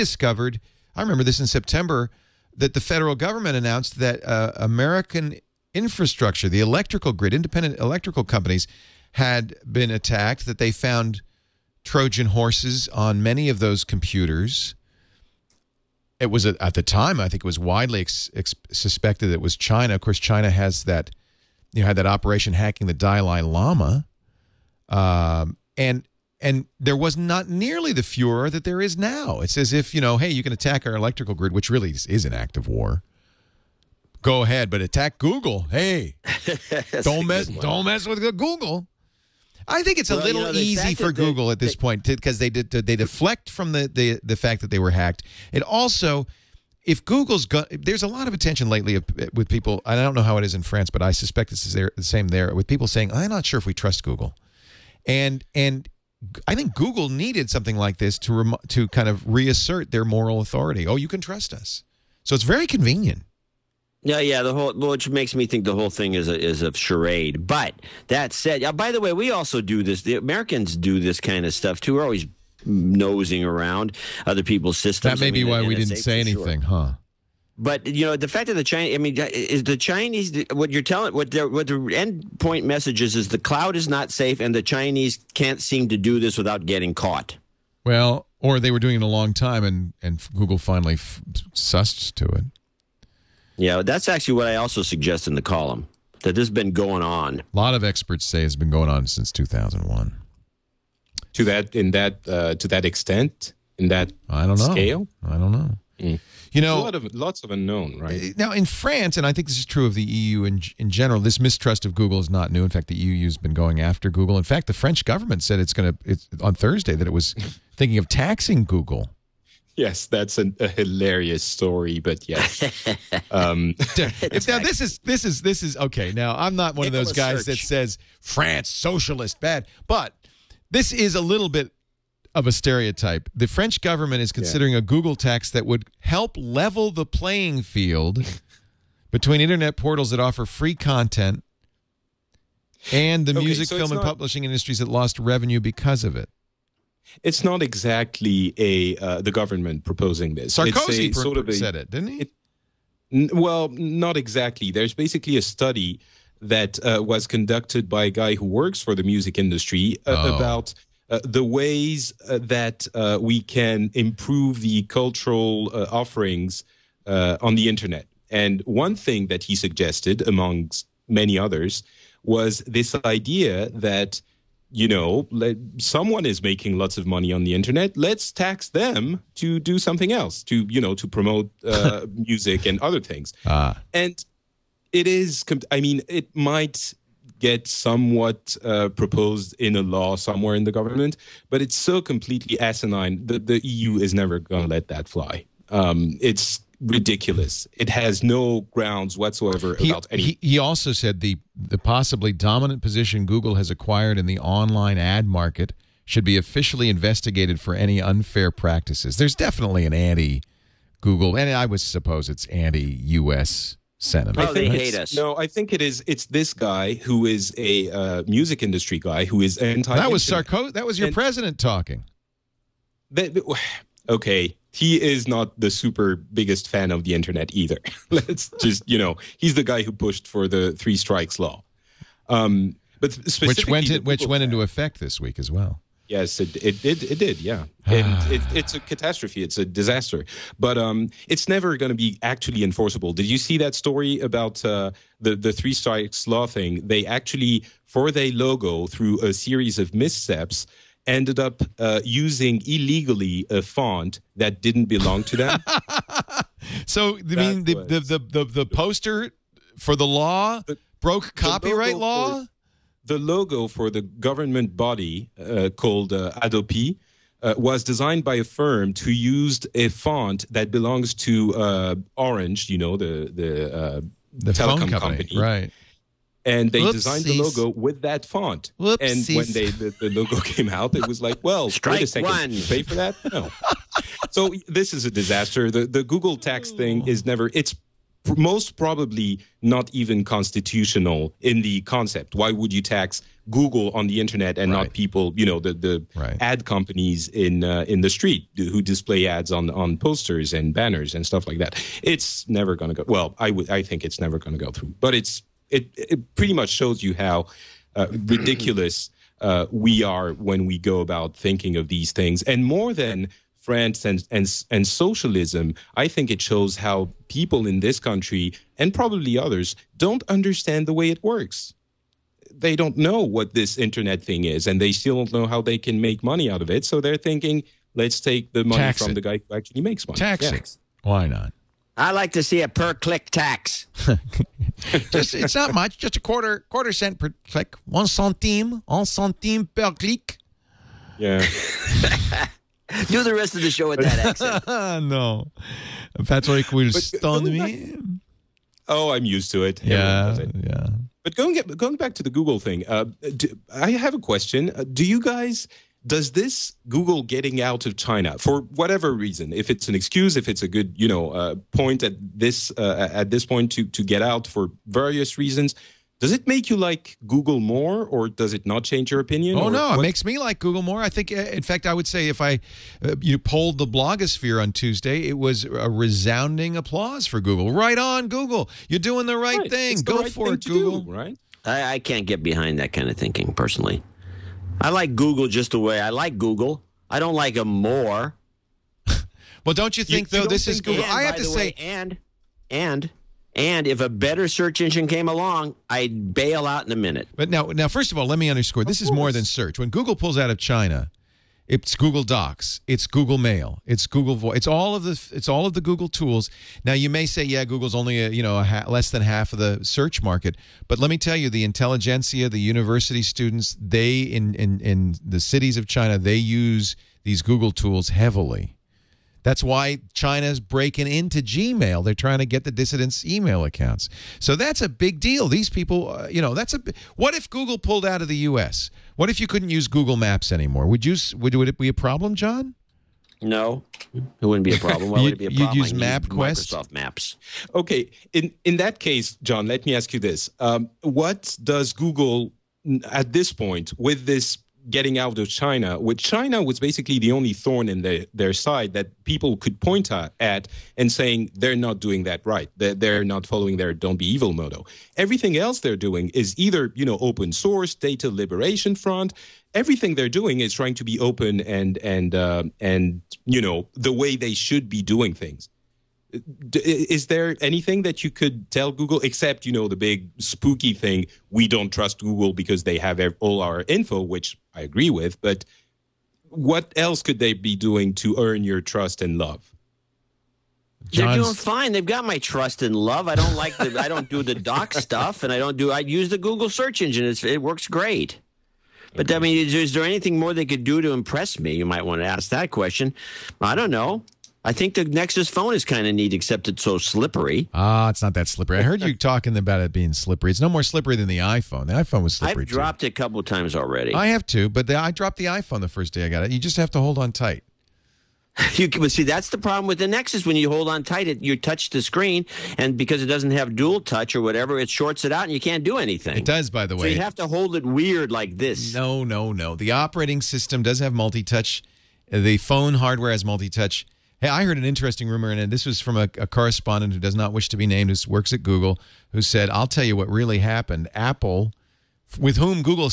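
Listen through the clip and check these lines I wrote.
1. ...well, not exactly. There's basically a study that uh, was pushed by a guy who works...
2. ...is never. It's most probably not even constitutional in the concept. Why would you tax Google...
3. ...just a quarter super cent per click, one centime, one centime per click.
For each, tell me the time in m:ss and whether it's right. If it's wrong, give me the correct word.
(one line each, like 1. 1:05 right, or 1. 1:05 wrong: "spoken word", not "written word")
1. 2:33 wrong: "conducted", not "pushed"
2. 4:47 right
3. 5:35 wrong: "quarter", not "super".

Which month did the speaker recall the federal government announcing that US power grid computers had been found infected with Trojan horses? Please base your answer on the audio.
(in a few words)
September.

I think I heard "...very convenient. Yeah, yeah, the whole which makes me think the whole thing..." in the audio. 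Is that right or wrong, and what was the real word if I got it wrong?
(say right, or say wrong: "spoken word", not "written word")
right.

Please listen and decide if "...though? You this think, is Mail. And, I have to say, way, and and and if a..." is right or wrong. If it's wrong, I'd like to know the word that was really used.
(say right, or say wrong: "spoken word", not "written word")
wrong: "Google", not "Mail".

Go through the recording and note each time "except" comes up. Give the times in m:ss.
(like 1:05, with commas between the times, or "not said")
7:49, 8:16.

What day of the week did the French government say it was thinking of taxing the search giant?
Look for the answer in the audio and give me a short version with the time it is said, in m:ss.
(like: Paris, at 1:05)
Thursday, at 1:56.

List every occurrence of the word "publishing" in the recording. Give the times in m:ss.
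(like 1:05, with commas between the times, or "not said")
2:24.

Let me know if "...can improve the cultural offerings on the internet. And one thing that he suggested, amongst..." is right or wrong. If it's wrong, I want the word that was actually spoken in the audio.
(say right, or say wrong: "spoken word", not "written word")
right.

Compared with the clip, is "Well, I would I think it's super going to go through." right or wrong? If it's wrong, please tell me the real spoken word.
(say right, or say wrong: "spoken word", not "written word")
wrong: "never", not "super".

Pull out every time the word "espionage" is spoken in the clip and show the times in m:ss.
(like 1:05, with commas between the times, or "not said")
not said.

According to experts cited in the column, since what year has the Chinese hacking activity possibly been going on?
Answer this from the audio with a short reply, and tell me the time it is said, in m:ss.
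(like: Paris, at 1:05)
2001, at 1:39.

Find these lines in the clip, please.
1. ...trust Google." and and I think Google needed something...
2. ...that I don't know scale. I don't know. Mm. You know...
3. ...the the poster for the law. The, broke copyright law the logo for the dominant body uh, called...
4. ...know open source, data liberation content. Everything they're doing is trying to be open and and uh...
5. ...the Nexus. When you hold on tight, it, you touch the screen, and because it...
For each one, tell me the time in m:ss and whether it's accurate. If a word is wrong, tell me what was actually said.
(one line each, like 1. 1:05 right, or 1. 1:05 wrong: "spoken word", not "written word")
1. 0:53 right
2. 1:43 right
3. 4:18 wrong: "government", not "dominant"
4. 7:37 wrong: "front", not "content"
5. 8:29 right.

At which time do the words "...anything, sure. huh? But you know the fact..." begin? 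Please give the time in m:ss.
1:16.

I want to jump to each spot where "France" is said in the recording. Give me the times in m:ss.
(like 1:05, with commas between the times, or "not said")
0:50, 1:48, 2:08, 5:13.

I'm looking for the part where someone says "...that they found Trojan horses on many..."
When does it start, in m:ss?
0:10.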